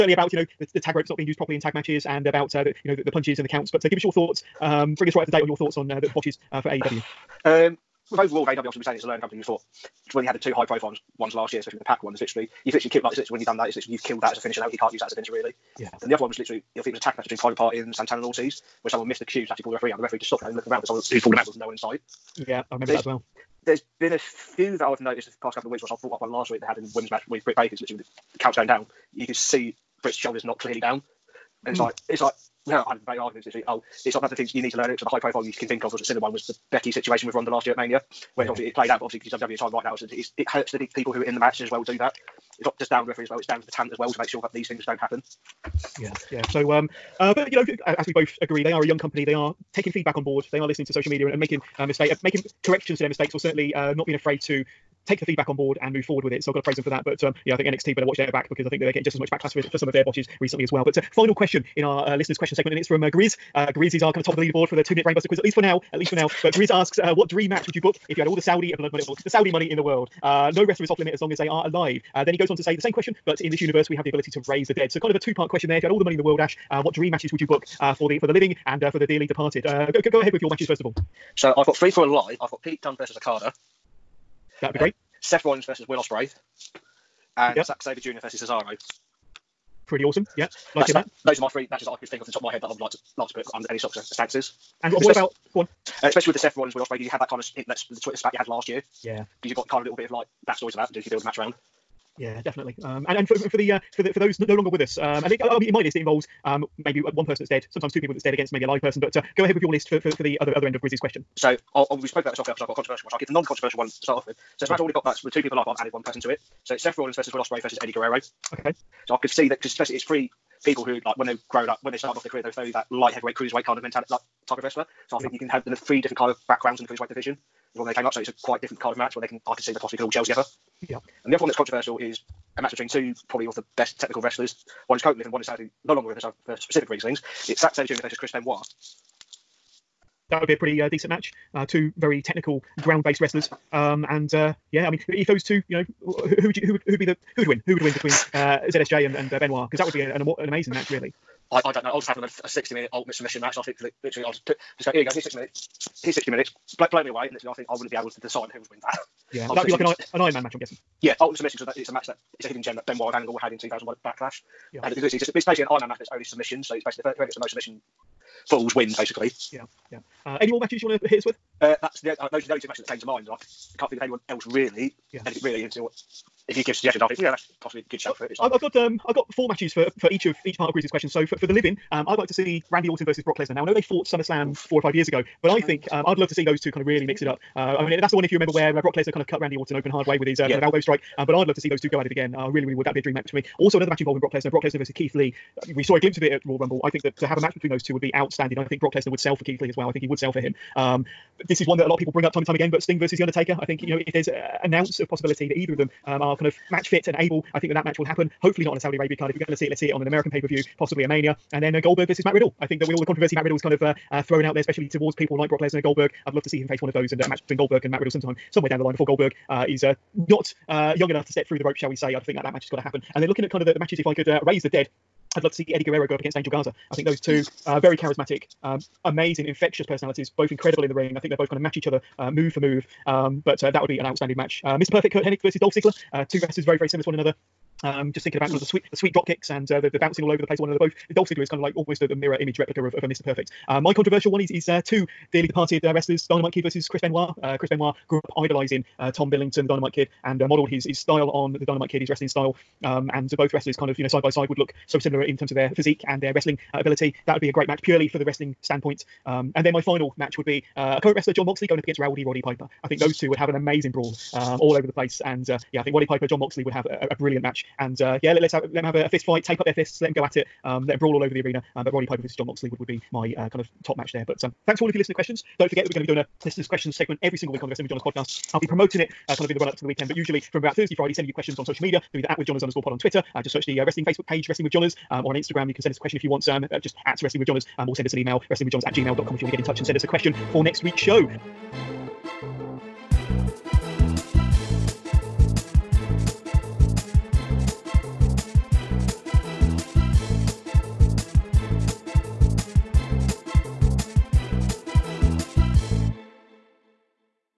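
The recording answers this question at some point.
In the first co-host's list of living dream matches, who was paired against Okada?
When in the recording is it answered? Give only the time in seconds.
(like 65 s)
82 s.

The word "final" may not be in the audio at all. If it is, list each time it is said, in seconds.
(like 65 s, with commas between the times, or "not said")
61 s, 259 s.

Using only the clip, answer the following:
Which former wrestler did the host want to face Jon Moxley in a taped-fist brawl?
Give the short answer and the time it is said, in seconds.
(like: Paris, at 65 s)
Rowdy Roddy Piper, at 261 s.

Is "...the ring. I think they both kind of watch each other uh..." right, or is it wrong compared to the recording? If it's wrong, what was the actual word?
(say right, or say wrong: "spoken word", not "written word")
wrong: "match", not "watch".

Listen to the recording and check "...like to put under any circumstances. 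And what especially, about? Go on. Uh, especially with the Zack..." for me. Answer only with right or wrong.
wrong.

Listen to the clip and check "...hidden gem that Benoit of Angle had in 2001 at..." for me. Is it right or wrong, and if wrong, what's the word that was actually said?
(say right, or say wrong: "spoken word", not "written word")
right.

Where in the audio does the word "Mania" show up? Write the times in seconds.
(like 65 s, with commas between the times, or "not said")
37 s, 211 s.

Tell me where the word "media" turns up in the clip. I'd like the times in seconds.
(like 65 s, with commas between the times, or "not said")
51 s, 281 s.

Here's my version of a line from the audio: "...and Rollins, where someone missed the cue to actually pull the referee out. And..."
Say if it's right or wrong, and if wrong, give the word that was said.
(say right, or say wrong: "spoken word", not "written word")
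wrong: "Ortiz", not "Rollins".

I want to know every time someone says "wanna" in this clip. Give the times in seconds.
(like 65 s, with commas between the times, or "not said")
not said.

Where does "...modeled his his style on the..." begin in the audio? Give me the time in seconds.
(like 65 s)
250 s.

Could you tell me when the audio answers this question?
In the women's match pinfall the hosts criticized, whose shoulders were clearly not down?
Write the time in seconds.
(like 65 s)
27 s.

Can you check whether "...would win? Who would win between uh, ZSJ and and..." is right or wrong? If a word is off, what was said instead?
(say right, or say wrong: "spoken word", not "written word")
right.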